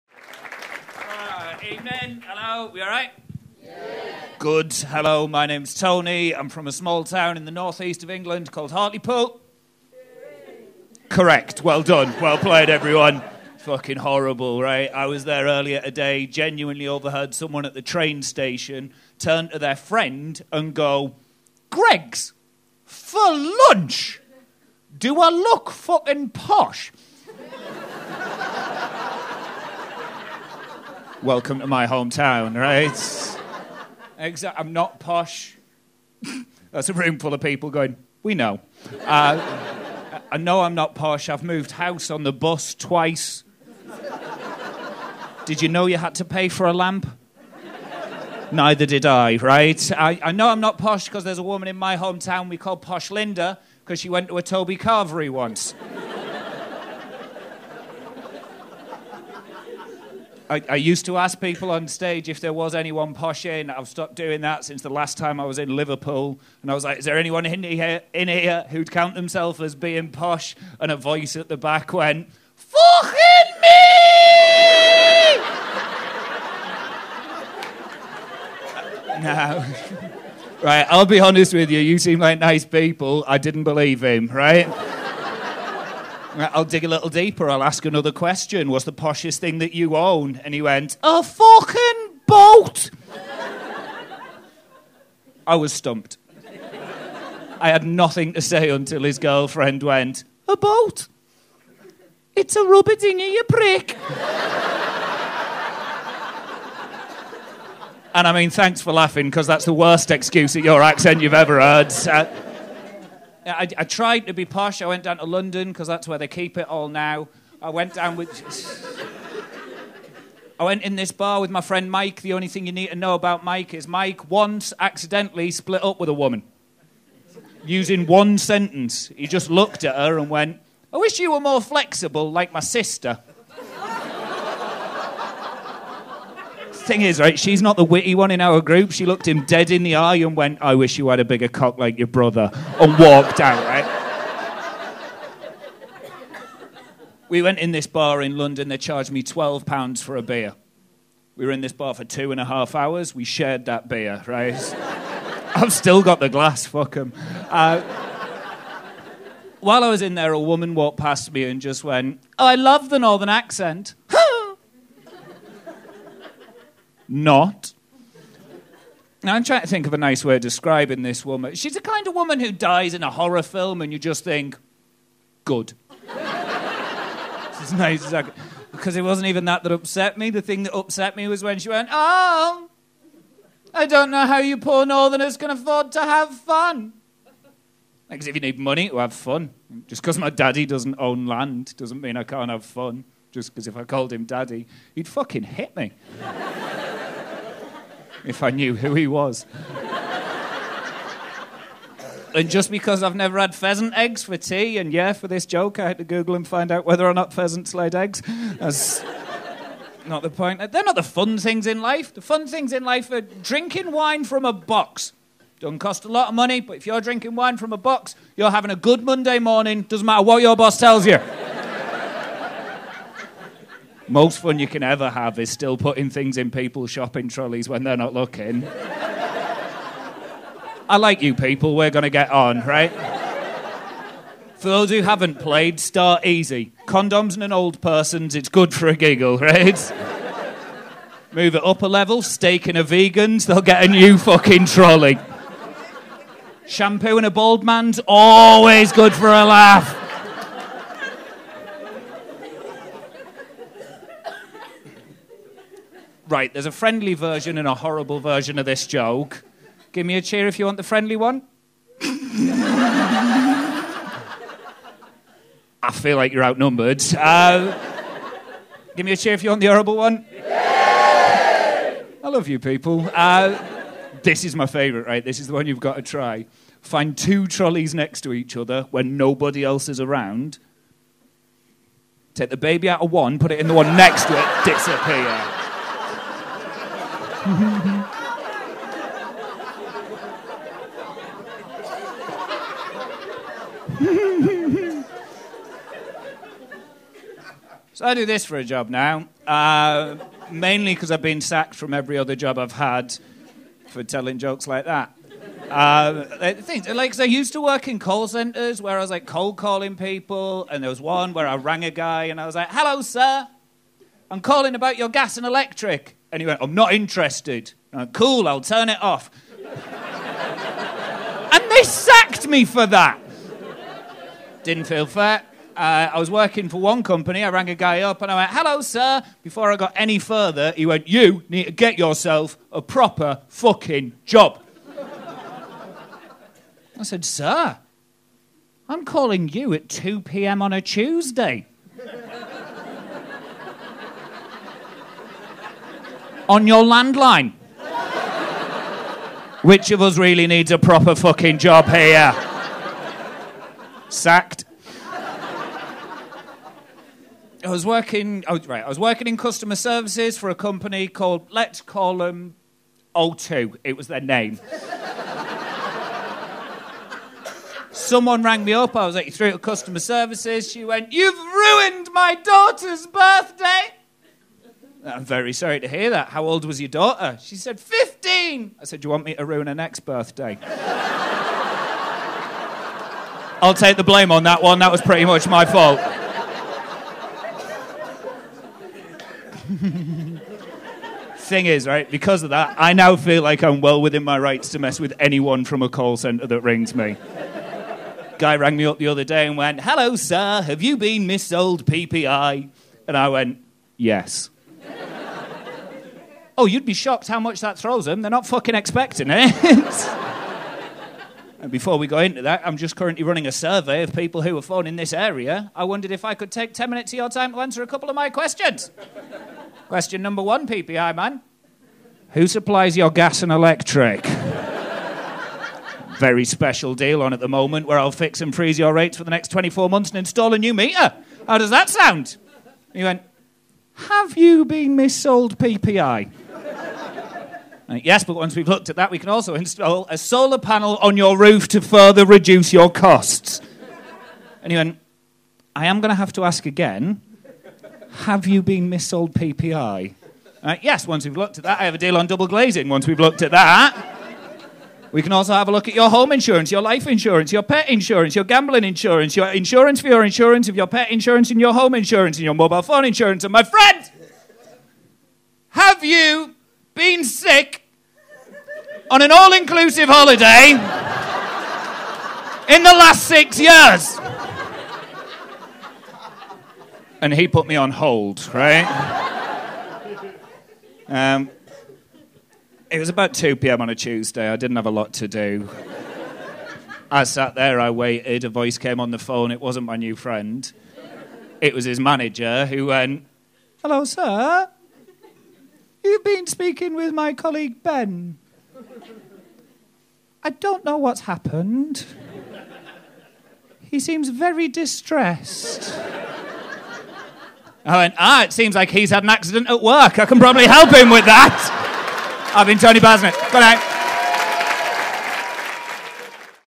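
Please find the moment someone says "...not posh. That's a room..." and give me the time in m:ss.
0:34.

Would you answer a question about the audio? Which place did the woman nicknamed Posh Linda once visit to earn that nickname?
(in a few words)
Toby Carvery.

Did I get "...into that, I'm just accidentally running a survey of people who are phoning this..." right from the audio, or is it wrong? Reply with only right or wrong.
wrong.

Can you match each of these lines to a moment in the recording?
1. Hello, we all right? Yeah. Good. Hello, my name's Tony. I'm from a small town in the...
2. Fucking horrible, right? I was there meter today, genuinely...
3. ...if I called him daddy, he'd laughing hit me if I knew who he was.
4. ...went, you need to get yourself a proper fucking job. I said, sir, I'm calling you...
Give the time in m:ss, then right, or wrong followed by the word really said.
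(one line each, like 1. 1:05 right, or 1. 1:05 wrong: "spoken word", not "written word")
1. 0:02 right
2. 0:13 wrong: "earlier", not "meter"
3. 3:13 wrong: "fucking", not "laughing"
4. 5:30 right.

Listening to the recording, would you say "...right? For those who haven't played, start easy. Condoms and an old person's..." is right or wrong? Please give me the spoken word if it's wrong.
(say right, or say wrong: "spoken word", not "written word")
right.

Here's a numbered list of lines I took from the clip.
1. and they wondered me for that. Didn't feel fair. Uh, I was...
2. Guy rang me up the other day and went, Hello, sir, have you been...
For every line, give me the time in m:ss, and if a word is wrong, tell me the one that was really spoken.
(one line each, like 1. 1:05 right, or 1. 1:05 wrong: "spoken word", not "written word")
1. 5:21 wrong: "sacked", not "wondered"
2. 6:38 right.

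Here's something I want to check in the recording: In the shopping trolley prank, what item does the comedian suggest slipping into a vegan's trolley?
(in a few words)
Steak.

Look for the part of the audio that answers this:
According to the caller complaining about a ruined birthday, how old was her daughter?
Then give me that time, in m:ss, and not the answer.
6:17.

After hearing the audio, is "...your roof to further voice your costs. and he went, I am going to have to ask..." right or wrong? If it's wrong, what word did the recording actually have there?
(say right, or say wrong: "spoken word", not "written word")
wrong: "reduce", not "voice".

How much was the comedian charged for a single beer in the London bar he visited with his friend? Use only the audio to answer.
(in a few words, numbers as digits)
12 pounds.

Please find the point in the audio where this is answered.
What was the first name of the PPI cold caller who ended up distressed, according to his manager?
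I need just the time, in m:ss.
8:17.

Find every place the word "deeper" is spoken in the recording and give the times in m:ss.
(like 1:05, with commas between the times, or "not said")
1:27.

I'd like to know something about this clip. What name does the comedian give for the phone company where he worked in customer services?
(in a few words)
O2.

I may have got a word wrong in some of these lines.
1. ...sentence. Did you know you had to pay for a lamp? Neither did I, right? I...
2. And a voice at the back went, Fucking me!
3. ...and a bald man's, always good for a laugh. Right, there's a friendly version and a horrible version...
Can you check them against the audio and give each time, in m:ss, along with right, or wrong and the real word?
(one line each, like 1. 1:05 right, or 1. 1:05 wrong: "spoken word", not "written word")
1. 0:42 wrong: "twice", not "sentence"
2. 1:10 right
3. 4:07 right.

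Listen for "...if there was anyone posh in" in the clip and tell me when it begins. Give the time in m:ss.
1:02.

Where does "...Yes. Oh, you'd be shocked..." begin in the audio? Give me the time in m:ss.
6:43.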